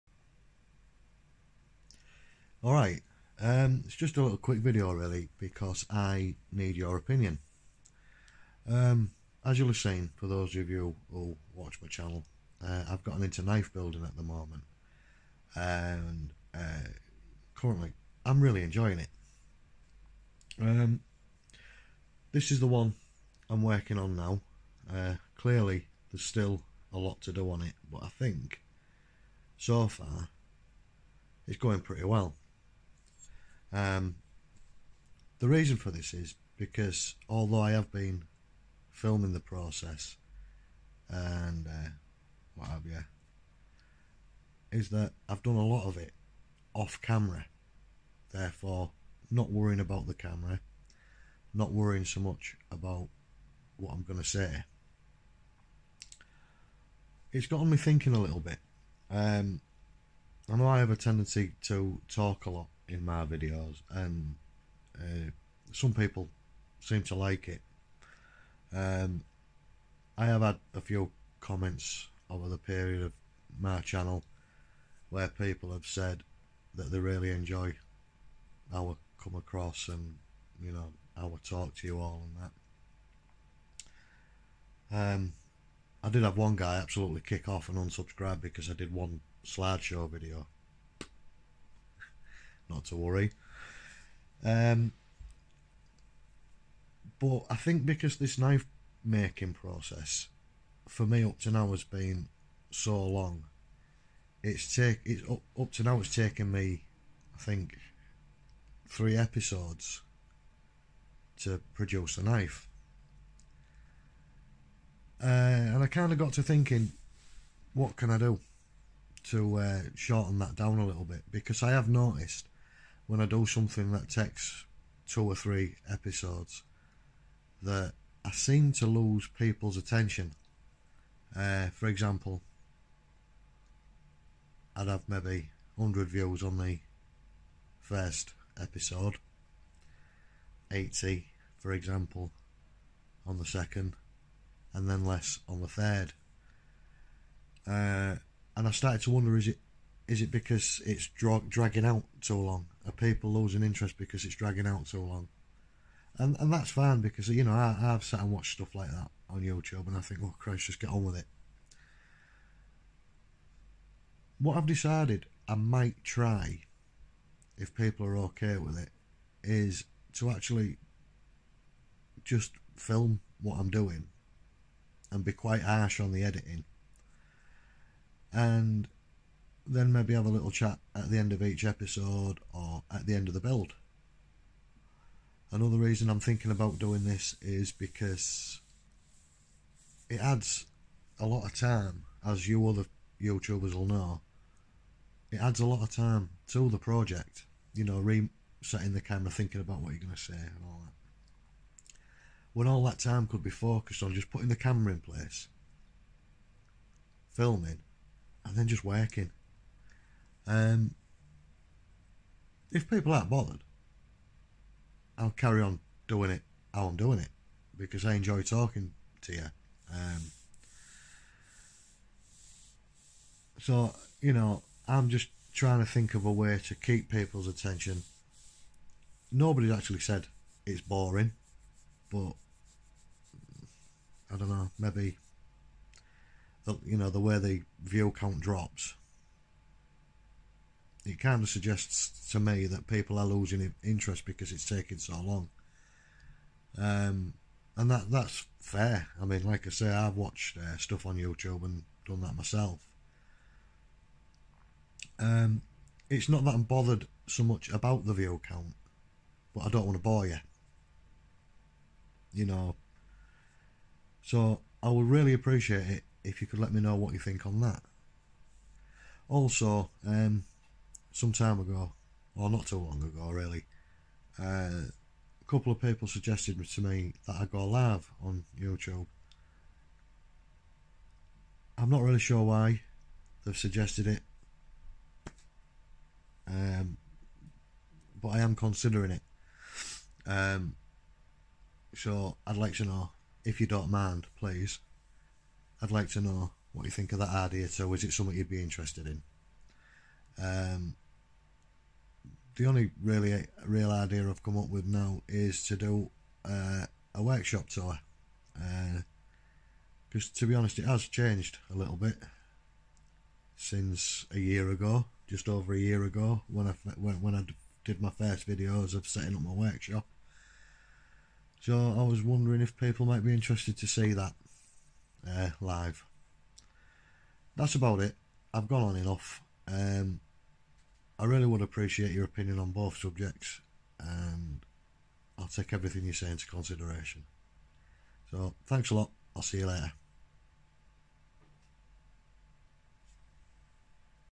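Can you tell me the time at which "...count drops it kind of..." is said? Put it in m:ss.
3:58.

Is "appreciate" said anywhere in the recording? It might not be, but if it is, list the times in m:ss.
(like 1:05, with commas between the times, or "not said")
4:25, 5:31.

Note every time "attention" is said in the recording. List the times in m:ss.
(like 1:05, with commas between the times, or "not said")
2:09, 3:47.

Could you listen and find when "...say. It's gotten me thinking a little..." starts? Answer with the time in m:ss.
0:54.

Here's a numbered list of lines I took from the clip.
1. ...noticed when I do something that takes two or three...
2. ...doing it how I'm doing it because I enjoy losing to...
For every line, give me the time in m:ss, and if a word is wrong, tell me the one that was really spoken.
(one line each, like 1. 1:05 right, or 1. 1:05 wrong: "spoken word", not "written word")
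1. 2:01 right
2. 3:36 wrong: "talking", not "losing".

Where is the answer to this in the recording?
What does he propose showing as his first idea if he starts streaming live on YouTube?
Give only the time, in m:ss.
5:07.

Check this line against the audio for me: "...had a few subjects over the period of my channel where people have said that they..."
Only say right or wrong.
wrong.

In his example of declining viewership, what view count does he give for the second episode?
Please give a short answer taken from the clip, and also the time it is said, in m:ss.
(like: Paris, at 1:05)
80, at 2:20.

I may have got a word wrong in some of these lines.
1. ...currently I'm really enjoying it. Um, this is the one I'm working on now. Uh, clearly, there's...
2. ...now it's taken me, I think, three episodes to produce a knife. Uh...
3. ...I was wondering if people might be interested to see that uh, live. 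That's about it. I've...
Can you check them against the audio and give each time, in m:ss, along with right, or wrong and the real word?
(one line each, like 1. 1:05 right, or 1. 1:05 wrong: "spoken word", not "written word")
1. 0:17 right
2. 1:45 right
3. 5:21 right.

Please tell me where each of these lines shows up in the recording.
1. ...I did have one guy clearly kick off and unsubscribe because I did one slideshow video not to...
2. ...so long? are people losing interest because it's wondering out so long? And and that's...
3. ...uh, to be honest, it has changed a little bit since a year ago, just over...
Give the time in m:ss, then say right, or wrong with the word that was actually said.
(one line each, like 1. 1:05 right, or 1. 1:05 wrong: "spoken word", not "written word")
1. 1:26 wrong: "absolutely", not "clearly"
2. 2:32 wrong: "dragging", not "wondering"
3. 5:10 right.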